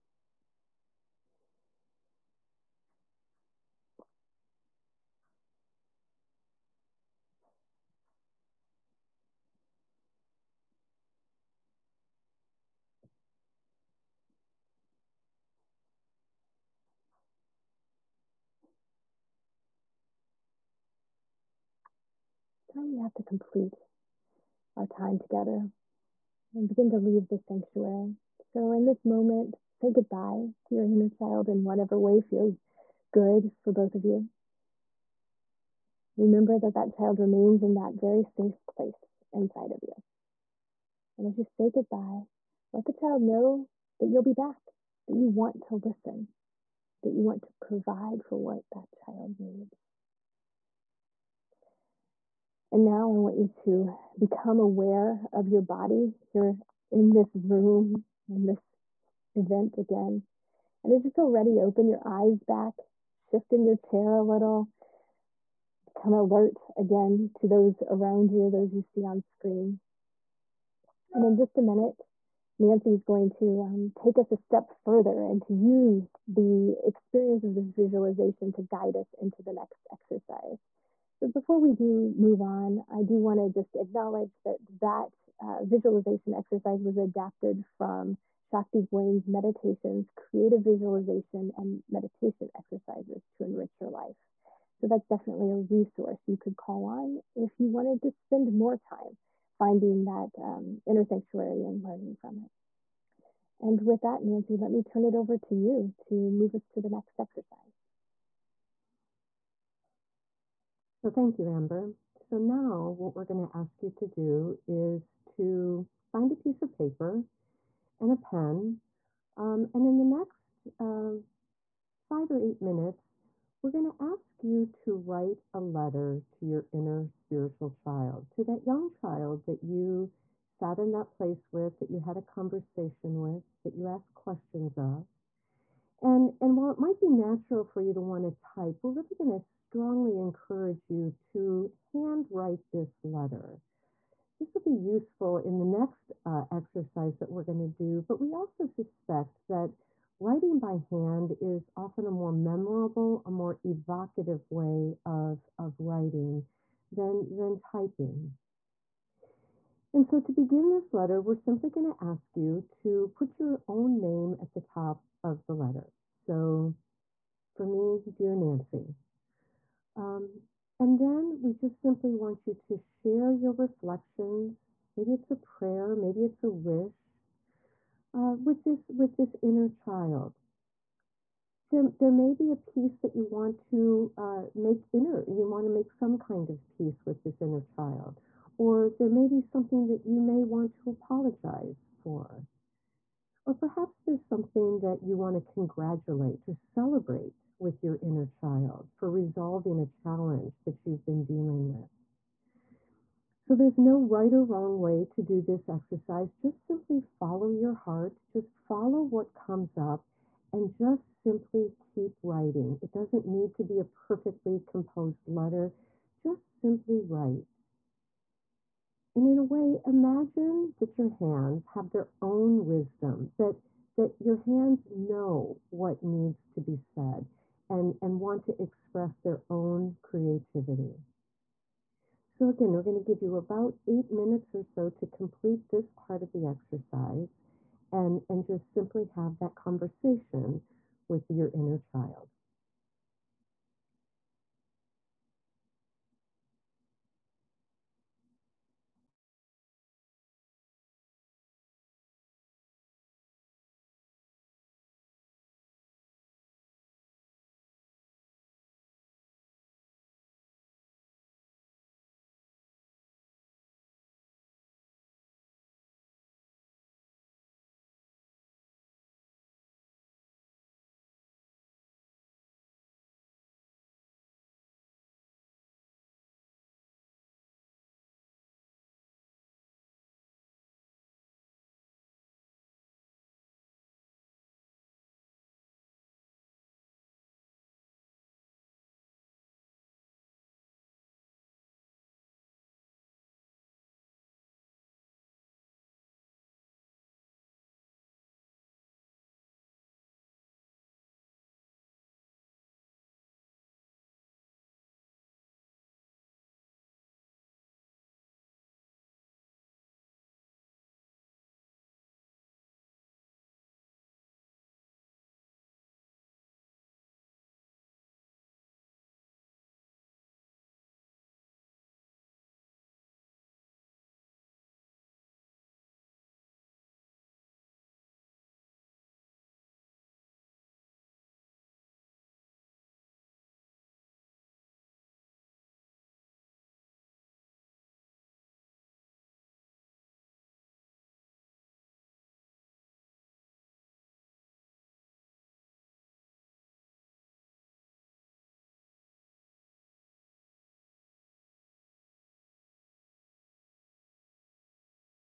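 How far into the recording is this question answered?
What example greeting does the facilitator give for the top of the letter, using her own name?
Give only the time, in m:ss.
2:48.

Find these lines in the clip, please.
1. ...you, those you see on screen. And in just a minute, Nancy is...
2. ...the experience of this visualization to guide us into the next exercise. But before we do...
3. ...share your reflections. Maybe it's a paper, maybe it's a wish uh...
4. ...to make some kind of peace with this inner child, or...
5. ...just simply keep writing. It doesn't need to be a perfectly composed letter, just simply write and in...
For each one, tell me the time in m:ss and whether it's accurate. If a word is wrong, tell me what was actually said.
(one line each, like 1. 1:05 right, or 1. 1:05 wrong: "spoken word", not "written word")
1. 1:08 right
2. 1:16 right
3. 2:52 wrong: "prayer", not "paper"
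4. 3:05 right
5. 3:30 right.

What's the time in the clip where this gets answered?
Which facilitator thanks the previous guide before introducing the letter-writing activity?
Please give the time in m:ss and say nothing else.
1:51.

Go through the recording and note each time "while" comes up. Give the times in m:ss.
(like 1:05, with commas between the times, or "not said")
2:16.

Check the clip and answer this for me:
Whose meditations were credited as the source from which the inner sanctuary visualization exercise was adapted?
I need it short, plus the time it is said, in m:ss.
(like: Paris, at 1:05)
Shakti Gawain, at 1:28.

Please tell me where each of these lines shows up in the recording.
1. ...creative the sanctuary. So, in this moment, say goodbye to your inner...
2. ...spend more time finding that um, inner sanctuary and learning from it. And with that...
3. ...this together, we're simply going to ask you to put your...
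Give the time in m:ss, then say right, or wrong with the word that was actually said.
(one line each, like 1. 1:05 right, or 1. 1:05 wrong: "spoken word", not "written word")
1. 0:26 wrong: "leave", not "creative"
2. 1:38 right
3. 2:40 wrong: "letter", not "together".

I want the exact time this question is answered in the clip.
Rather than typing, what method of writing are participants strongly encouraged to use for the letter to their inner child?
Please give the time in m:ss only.
2:21.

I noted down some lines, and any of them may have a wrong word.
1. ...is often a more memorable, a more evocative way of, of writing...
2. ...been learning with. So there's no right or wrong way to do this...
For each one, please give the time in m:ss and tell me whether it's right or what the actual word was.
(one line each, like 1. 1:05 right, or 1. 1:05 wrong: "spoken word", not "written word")
1. 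2:31 right
2. 3:21 wrong: "dealing", not "learning".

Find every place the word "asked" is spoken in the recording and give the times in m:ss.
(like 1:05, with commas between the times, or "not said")
2:13.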